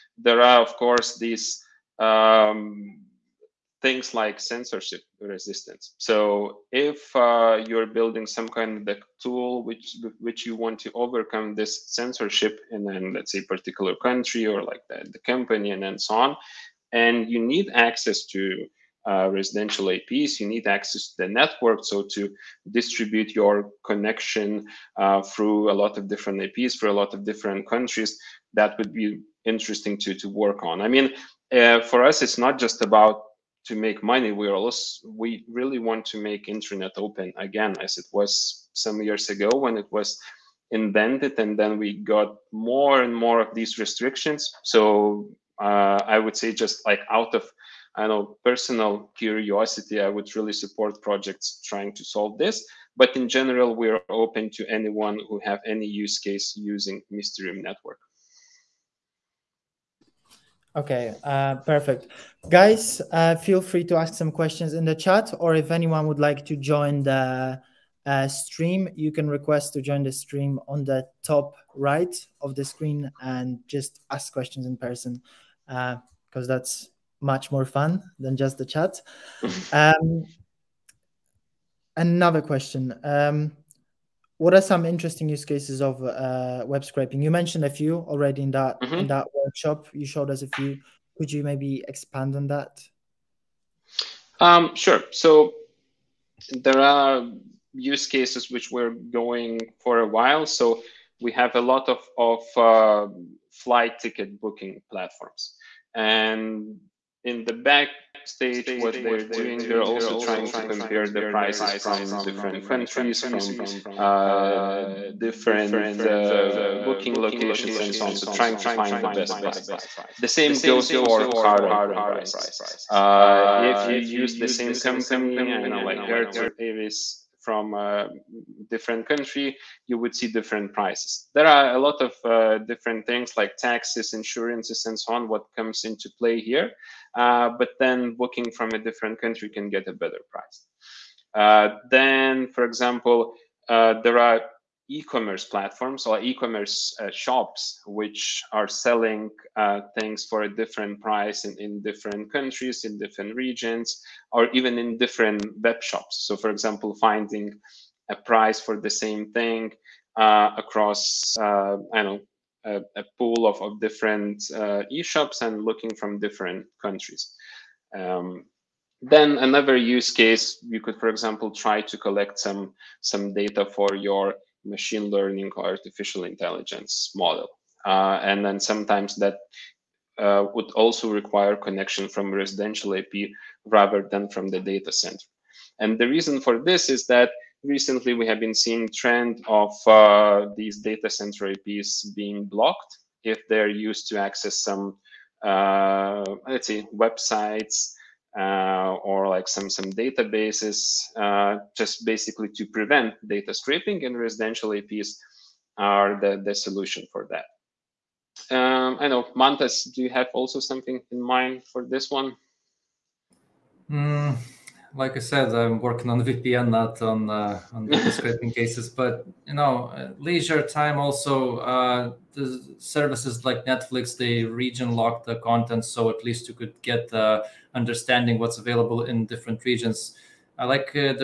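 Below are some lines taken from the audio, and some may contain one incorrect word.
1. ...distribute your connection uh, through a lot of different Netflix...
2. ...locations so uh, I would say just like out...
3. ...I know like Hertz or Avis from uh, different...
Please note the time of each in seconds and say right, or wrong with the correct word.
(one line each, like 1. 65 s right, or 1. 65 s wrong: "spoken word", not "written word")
1. 22 s wrong: "APs", not "Netflix"
2. 43 s wrong: "restrictions", not "locations"
3. 125 s right.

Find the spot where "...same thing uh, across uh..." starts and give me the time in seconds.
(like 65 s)
158 s.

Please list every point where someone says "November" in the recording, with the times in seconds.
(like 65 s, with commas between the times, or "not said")
not said.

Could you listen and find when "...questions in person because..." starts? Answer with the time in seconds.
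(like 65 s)
74 s.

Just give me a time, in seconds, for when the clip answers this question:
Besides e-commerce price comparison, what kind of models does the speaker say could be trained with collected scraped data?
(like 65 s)
174 s.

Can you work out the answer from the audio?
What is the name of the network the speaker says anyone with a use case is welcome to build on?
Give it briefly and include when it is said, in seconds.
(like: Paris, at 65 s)
Mysterium Network, at 57 s.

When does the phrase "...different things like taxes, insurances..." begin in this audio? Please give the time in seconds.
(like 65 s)
132 s.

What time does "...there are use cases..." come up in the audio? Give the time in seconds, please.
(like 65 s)
96 s.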